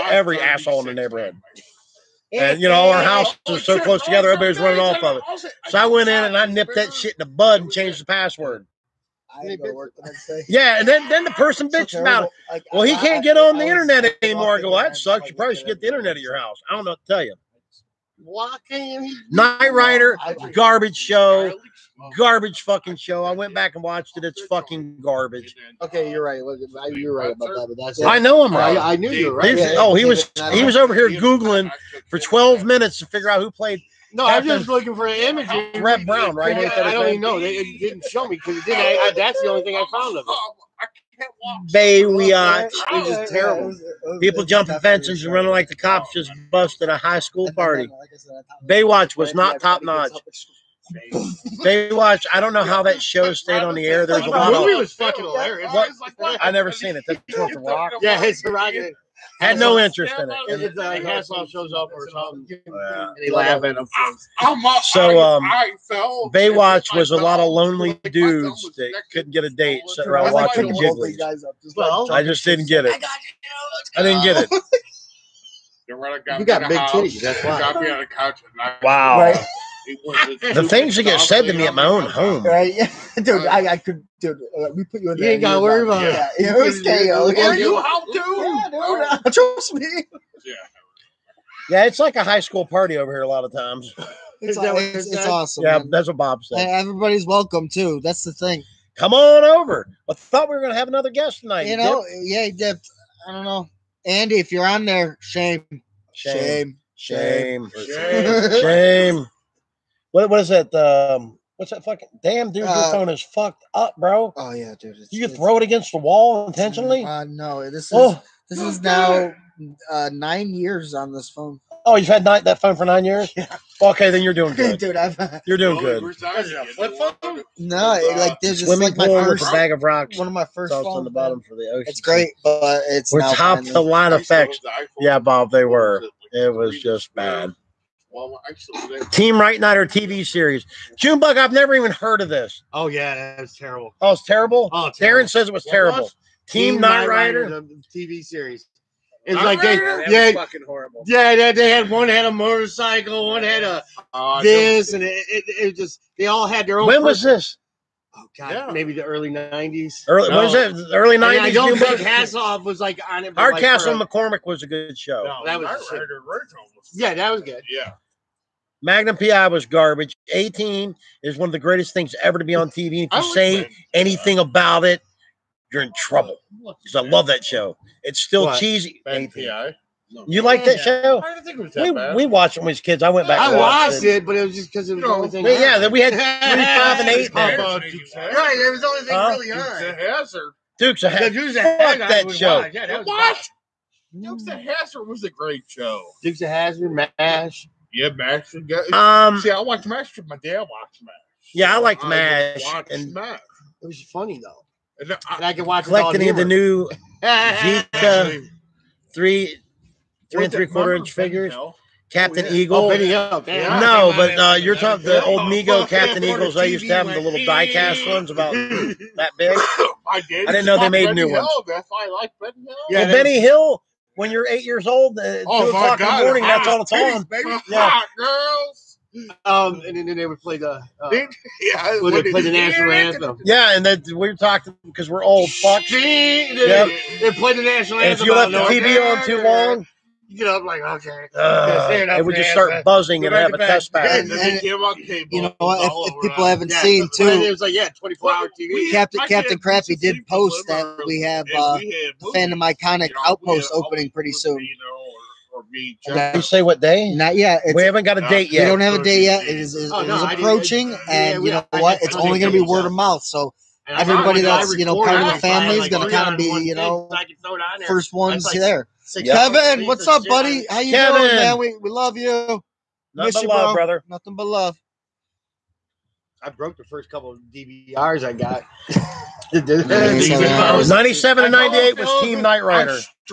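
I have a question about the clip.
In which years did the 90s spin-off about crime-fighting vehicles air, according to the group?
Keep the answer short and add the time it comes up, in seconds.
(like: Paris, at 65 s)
1997 and 1998, at 279 s.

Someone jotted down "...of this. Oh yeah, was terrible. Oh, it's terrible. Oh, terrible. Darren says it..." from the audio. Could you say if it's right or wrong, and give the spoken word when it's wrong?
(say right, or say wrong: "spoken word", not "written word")
right.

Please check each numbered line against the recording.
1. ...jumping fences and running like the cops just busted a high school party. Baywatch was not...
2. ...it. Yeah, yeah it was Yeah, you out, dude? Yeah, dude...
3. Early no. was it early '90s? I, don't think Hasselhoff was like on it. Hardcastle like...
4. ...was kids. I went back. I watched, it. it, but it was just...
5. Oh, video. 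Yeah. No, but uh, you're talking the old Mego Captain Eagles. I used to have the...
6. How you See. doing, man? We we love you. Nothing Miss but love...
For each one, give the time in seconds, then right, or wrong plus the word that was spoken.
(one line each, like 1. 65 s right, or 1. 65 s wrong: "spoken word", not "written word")
1. 44 s right
2. 86 s right
3. 160 s right
4. 182 s right
5. 212 s right
6. 270 s wrong: "Kevin", not "See".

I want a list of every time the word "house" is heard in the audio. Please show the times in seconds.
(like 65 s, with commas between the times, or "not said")
3 s, 16 s.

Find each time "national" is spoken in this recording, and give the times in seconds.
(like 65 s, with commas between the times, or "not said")
232 s, 237 s.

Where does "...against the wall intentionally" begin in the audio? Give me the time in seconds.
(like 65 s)
115 s.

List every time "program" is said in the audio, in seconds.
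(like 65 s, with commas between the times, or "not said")
not said.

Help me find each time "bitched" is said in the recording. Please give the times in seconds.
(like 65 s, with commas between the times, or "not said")
11 s.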